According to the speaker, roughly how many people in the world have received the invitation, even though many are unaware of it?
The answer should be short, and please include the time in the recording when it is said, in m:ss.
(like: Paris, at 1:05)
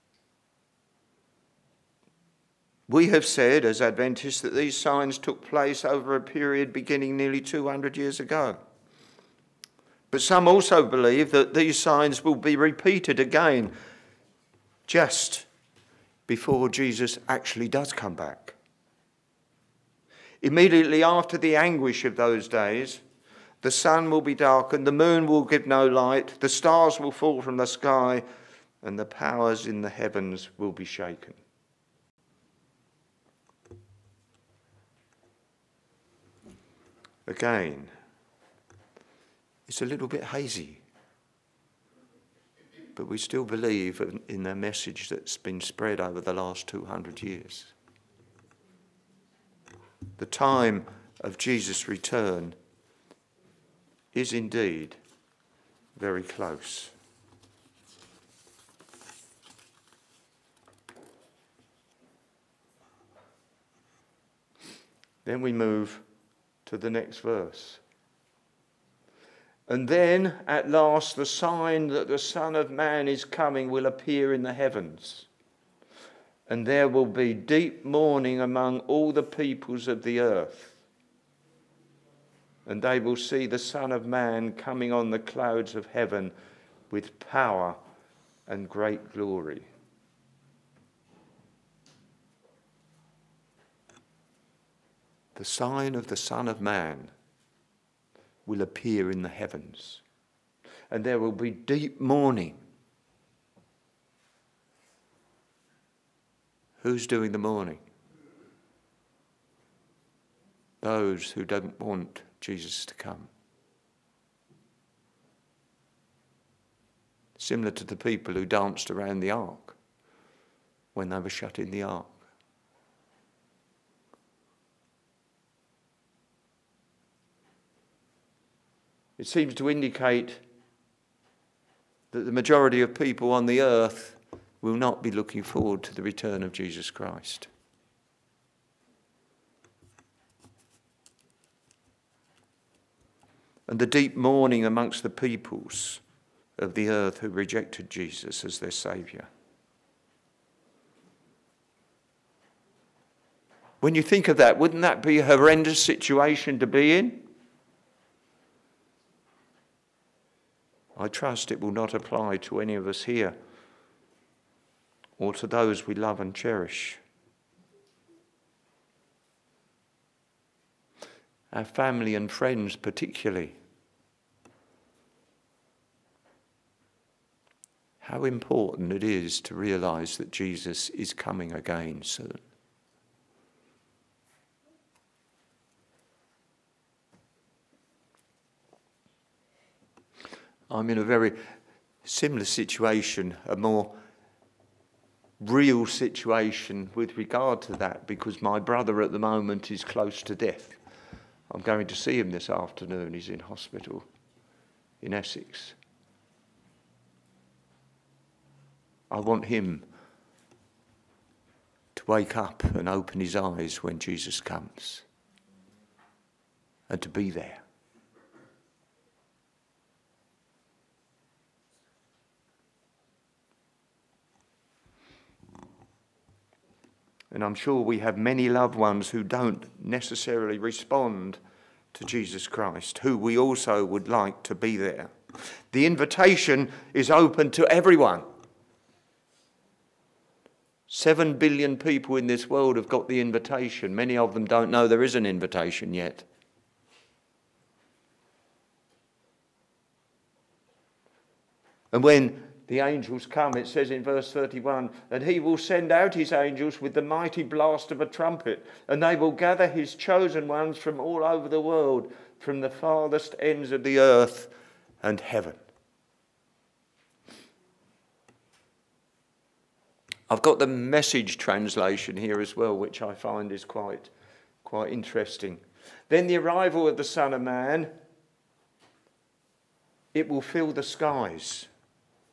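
7 billion, at 4:00.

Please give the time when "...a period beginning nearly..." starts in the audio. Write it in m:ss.
0:06.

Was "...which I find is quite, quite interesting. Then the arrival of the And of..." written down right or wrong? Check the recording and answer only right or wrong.
wrong.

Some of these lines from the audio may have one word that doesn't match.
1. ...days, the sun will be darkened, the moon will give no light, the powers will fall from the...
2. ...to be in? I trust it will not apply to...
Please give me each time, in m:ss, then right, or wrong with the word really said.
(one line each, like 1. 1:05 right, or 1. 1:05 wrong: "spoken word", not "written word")
1. 0:22 wrong: "stars", not "powers"
2. 2:36 right.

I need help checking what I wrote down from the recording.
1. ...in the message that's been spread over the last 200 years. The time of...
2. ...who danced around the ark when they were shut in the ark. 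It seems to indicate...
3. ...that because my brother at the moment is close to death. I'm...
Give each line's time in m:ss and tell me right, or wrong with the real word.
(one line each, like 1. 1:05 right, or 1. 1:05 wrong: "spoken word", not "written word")
1. 0:44 right
2. 1:58 right
3. 3:17 right.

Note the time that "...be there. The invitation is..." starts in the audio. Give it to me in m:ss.
3:54.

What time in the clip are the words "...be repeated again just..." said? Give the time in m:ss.
0:12.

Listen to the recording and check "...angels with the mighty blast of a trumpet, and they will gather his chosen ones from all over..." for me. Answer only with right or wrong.
right.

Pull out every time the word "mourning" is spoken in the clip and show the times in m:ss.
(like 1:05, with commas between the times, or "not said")
1:17, 1:42, 1:47, 2:24.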